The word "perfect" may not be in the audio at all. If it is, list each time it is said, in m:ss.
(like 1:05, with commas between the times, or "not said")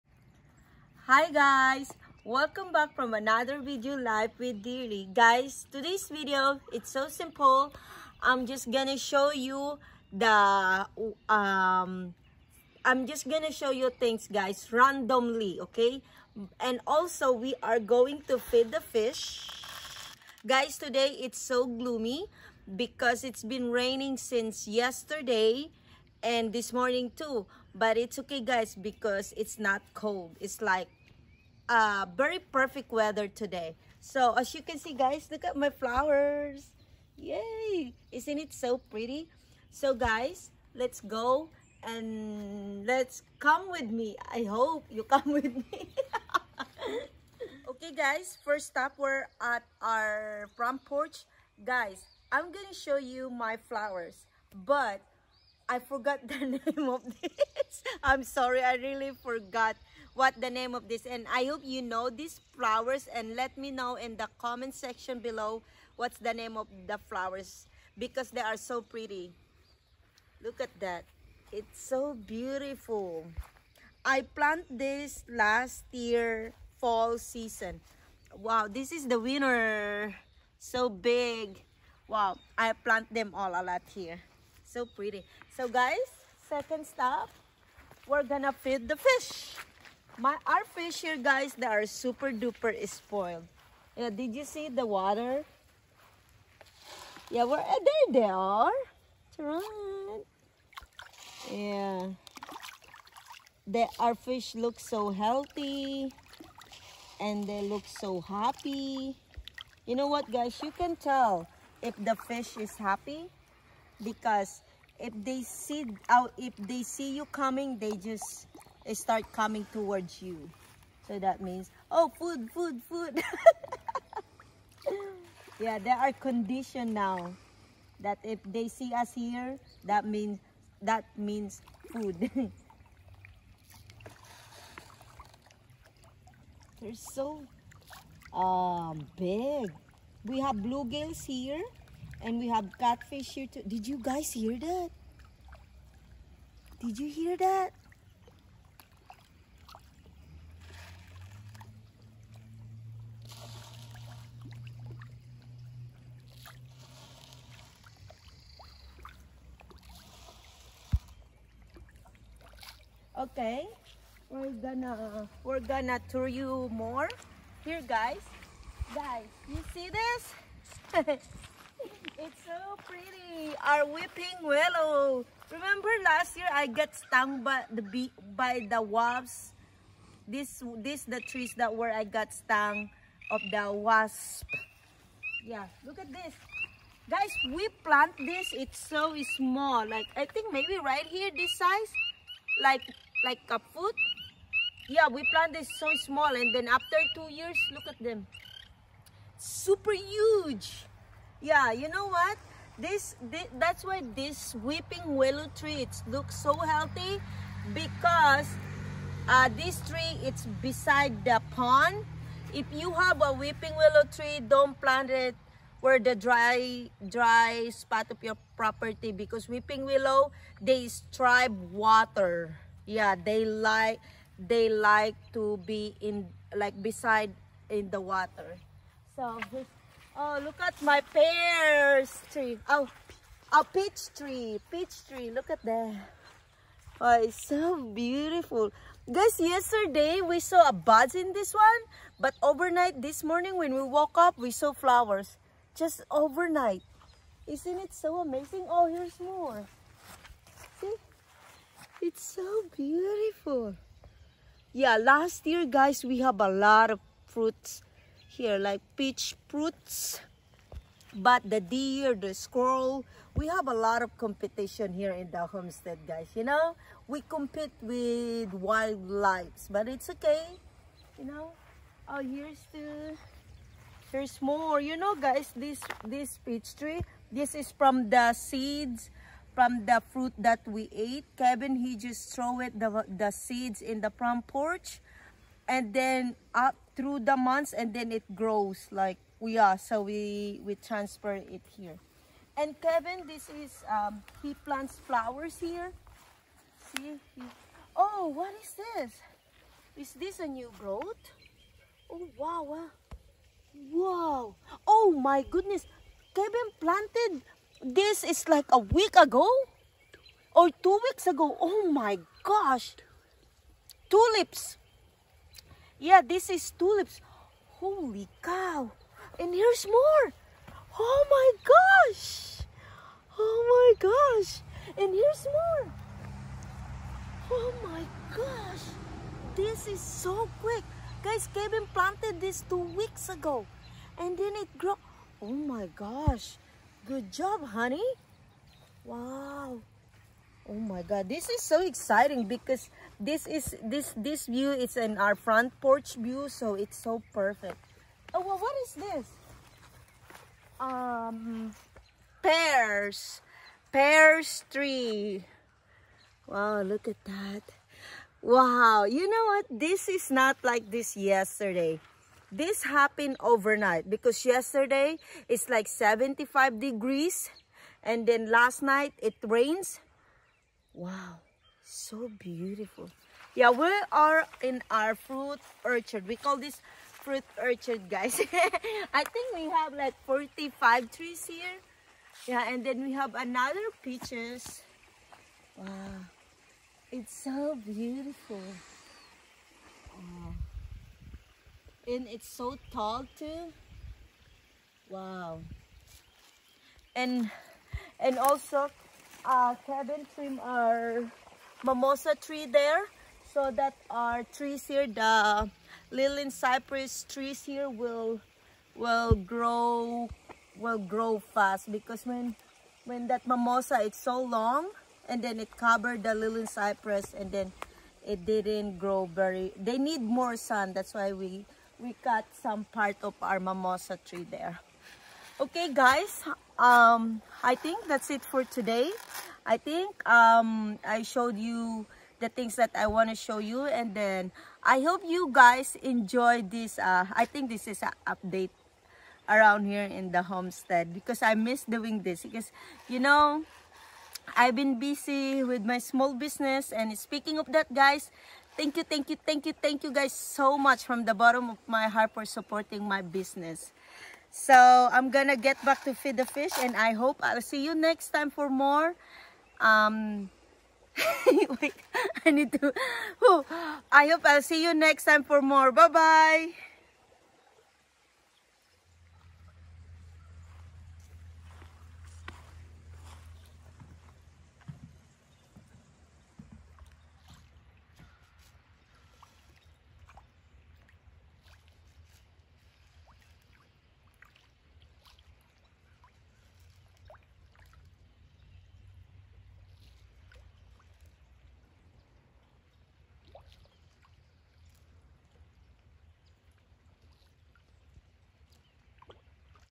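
0:32, 5:47.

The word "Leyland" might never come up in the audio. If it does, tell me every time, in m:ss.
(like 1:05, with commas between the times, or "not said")
6:46, 6:56.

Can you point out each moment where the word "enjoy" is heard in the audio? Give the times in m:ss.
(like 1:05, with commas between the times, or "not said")
7:16.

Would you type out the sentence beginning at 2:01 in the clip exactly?
So that means, oh, food, food, food.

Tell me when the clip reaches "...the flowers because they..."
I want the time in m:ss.
1:06.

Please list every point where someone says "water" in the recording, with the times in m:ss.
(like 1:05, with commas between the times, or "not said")
1:34, 3:41, 3:48.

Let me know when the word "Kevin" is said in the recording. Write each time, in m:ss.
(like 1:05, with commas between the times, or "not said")
4:41, 4:52, 5:06, 5:31, 6:39.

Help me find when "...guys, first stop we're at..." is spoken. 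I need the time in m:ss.
0:47.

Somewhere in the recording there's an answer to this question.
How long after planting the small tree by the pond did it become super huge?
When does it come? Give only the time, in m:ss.
3:17.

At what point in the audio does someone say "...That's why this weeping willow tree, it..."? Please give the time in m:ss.
3:23.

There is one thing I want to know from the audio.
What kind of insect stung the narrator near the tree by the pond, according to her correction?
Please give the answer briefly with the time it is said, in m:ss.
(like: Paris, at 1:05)
Wasps, at 2:58.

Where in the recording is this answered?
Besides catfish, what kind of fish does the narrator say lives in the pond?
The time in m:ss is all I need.
2:20.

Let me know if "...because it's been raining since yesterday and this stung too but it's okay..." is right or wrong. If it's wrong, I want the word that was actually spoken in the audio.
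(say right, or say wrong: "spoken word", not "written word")
wrong: "morning", not "stung".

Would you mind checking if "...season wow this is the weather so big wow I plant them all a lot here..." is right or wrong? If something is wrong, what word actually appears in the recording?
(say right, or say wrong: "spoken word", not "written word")
wrong: "winner", not "weather".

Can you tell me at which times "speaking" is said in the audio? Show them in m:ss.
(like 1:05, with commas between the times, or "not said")
7:27.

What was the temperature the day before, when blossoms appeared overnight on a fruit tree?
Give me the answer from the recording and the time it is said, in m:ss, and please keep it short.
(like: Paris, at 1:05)
75 degrees, at 6:05.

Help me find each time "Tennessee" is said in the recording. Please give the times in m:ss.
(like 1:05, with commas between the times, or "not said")
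not said.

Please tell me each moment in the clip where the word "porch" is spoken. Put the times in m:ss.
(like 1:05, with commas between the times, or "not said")
0:50, 4:44, 5:45.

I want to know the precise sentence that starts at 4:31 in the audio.
You know, oh, here's the, here's more.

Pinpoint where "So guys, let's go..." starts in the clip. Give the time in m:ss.
0:39.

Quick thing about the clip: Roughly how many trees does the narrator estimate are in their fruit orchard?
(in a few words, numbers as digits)
45.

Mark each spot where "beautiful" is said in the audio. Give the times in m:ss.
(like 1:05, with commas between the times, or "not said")
1:12, 3:57, 4:12, 6:12, 6:27.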